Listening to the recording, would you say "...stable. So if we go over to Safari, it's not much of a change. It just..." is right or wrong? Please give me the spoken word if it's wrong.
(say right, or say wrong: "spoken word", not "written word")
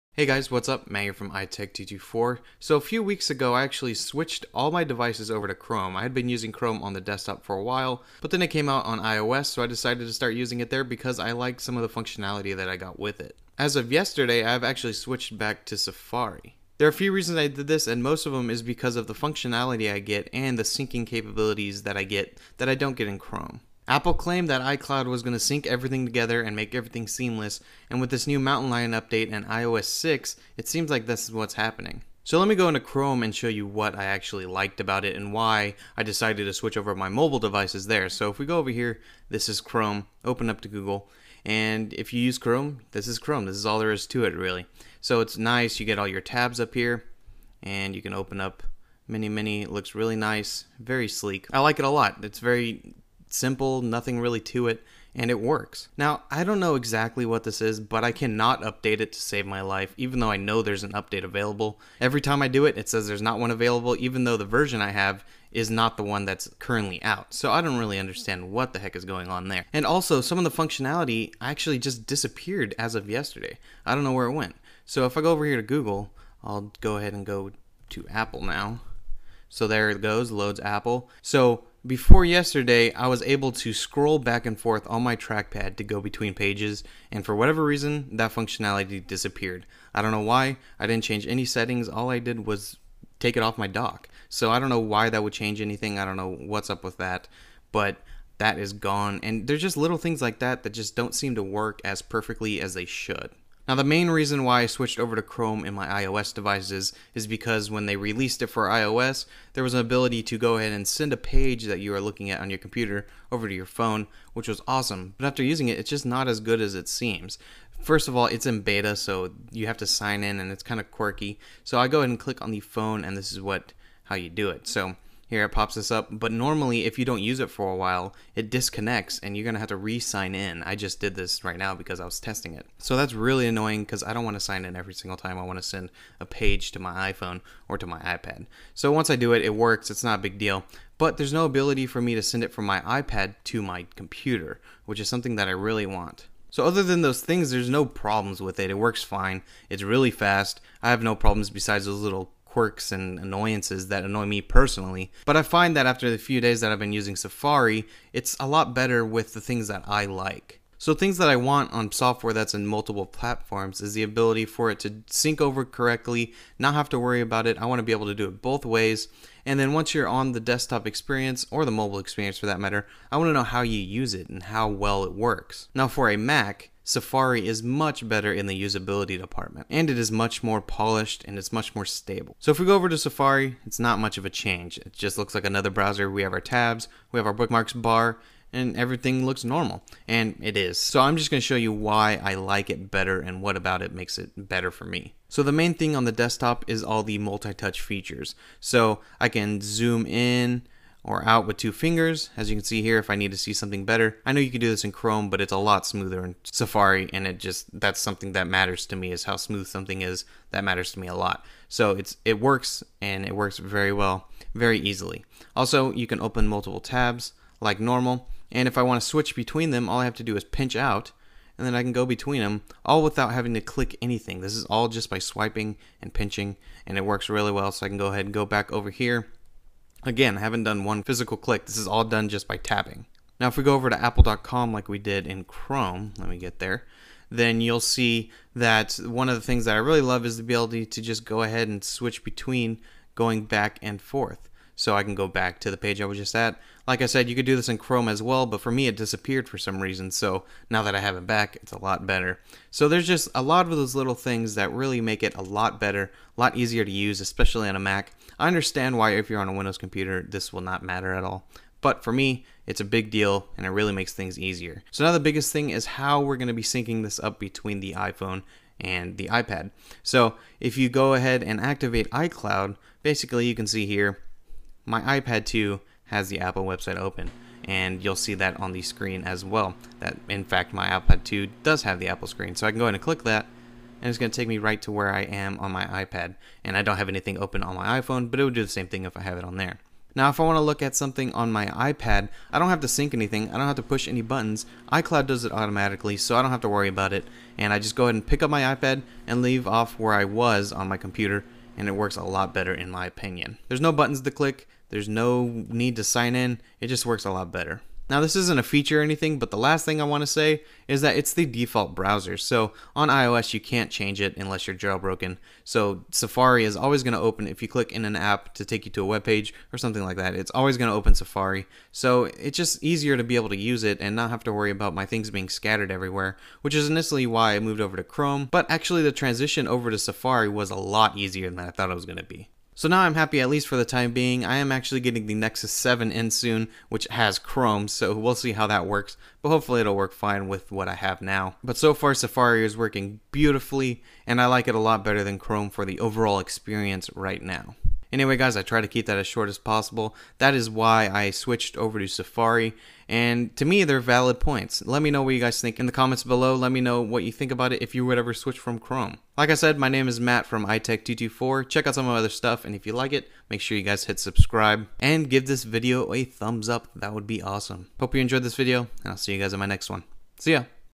right.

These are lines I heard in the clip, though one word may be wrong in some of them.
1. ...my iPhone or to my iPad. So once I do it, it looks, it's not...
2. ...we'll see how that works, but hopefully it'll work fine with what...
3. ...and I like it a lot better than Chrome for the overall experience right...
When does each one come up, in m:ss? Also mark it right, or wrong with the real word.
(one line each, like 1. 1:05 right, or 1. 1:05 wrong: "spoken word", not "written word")
1. 2:16 wrong: "works", not "looks"
2. 5:38 right
3. 5:44 right.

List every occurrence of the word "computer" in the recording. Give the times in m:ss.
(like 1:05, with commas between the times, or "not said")
1:52, 2:23, 4:19, 5:00.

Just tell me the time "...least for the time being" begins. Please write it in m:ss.
5:33.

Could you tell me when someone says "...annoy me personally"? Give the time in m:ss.
2:34.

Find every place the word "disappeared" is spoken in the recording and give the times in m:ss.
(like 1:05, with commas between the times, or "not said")
1:12, 1:29, 4:08.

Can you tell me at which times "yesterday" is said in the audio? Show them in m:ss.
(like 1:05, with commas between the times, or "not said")
0:13, 1:13, 1:22.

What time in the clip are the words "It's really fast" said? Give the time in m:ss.
2:29.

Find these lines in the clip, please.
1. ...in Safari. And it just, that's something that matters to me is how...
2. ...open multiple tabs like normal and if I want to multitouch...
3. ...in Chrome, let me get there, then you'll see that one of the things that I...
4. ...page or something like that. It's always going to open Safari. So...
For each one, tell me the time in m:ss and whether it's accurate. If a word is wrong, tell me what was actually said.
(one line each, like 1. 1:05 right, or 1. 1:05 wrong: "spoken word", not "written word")
1. 3:26 right
2. 3:36 wrong: "switch", not "multitouch"
3. 3:55 right
4. 5:19 right.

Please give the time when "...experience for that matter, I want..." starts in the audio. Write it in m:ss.
2:51.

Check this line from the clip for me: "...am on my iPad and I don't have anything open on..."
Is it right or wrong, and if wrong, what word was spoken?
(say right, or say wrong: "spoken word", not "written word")
right.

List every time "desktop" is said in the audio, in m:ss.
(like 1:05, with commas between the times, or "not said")
0:07, 2:50, 3:16.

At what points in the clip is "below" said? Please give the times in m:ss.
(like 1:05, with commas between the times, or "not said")
5:56.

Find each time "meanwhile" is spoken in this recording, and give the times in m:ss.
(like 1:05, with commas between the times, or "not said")
not said.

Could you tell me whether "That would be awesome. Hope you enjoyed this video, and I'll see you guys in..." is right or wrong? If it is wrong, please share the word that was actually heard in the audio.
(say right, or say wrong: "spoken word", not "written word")
right.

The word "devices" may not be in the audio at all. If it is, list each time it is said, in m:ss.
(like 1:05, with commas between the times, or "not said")
0:04, 0:37, 1:46.